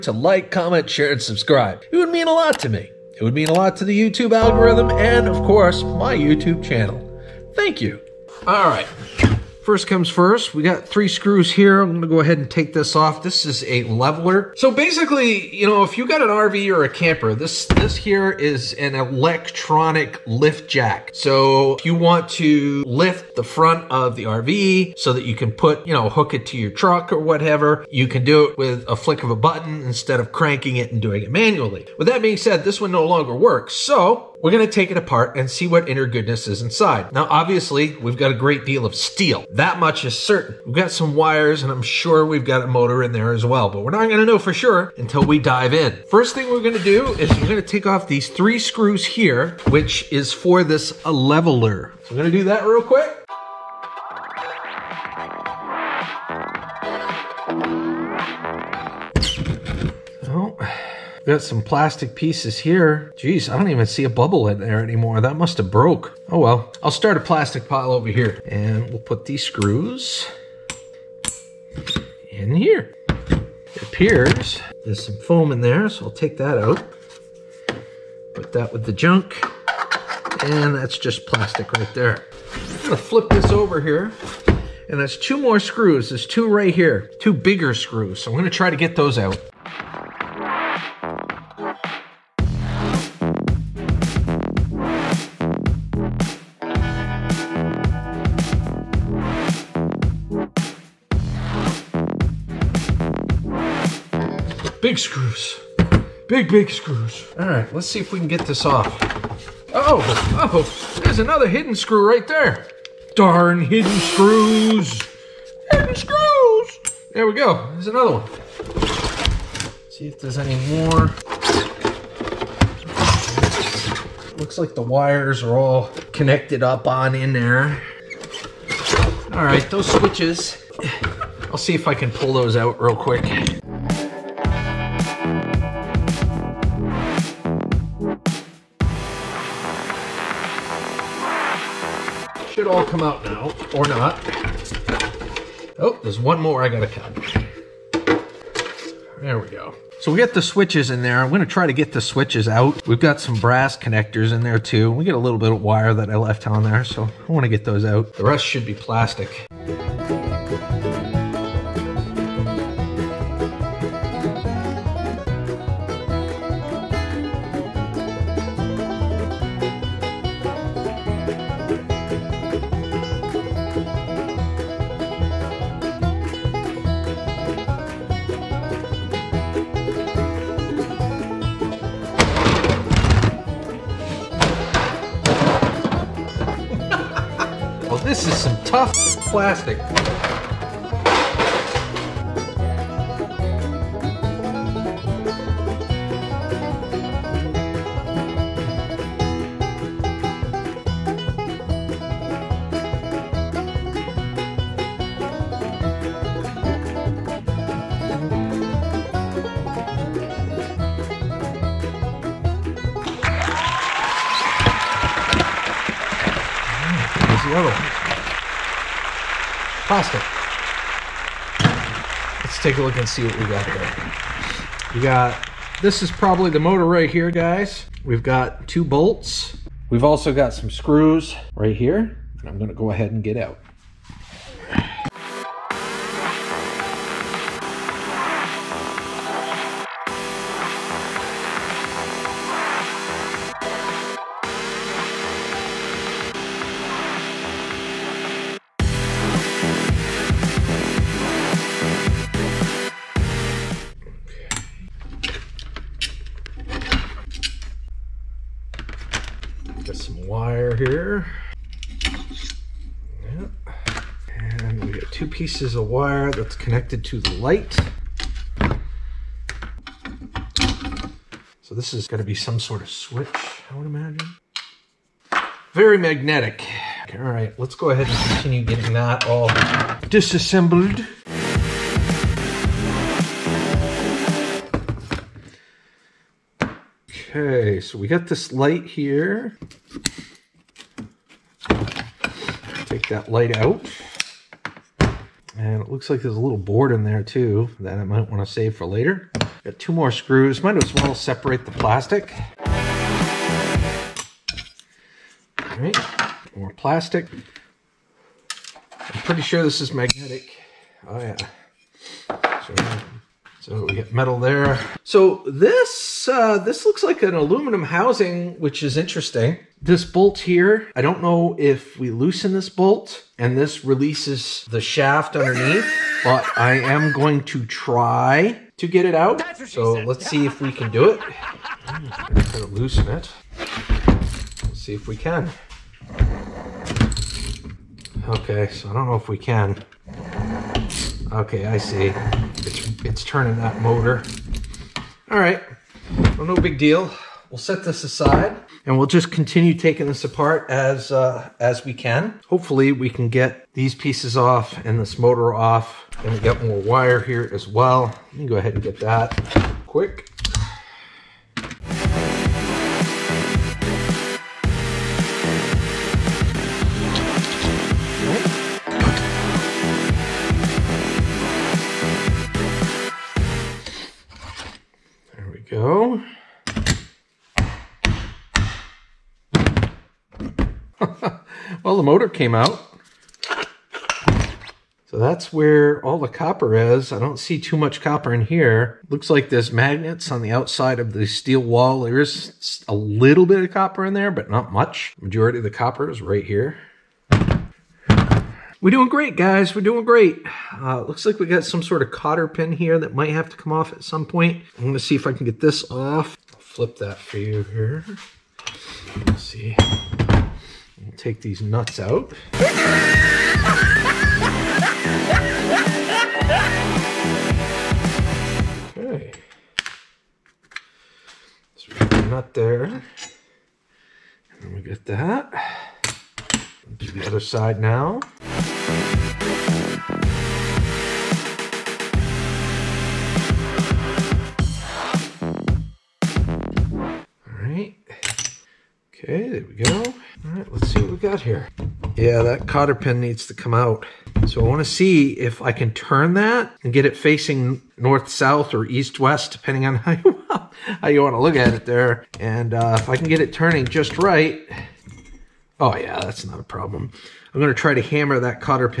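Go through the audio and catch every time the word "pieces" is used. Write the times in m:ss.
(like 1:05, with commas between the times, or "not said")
1:02, 4:25, 5:53.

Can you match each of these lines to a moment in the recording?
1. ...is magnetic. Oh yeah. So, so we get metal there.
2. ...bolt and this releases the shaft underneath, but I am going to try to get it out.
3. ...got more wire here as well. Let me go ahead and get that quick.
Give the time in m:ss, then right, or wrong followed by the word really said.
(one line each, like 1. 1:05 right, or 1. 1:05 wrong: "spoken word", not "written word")
1. 5:09 right
2. 5:22 right
3. 5:56 right.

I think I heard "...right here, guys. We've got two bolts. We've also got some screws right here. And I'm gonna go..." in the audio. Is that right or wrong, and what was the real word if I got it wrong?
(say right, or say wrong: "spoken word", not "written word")
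right.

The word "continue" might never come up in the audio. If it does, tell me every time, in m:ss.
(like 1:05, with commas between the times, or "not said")
4:38, 5:49.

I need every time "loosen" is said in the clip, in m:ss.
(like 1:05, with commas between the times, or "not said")
5:22, 5:32.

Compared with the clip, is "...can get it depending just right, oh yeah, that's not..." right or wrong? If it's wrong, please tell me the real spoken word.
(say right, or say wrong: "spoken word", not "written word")
wrong: "turning", not "depending".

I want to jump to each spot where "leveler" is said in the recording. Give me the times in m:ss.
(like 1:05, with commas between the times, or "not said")
0:13, 0:51.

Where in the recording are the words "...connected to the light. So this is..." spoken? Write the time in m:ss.
4:26.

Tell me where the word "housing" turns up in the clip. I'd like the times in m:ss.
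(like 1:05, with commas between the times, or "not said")
5:17.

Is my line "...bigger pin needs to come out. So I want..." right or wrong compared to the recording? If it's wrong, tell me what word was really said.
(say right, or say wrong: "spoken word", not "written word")
wrong: "cotter", not "bigger".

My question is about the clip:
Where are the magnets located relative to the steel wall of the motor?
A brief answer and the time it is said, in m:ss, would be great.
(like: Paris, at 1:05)
On the outside, at 6:30.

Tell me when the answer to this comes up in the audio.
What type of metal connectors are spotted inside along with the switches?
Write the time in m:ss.
2:33.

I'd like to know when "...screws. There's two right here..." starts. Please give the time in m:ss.
1:25.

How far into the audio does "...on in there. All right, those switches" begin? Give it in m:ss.
2:06.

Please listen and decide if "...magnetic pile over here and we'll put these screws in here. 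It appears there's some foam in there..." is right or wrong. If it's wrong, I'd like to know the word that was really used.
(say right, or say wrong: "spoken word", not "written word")
wrong: "plastic", not "magnetic".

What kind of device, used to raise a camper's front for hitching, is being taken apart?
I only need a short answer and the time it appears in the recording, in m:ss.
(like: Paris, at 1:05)
Electronic lift jack, at 0:18.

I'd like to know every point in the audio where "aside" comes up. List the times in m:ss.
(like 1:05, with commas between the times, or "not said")
5:48.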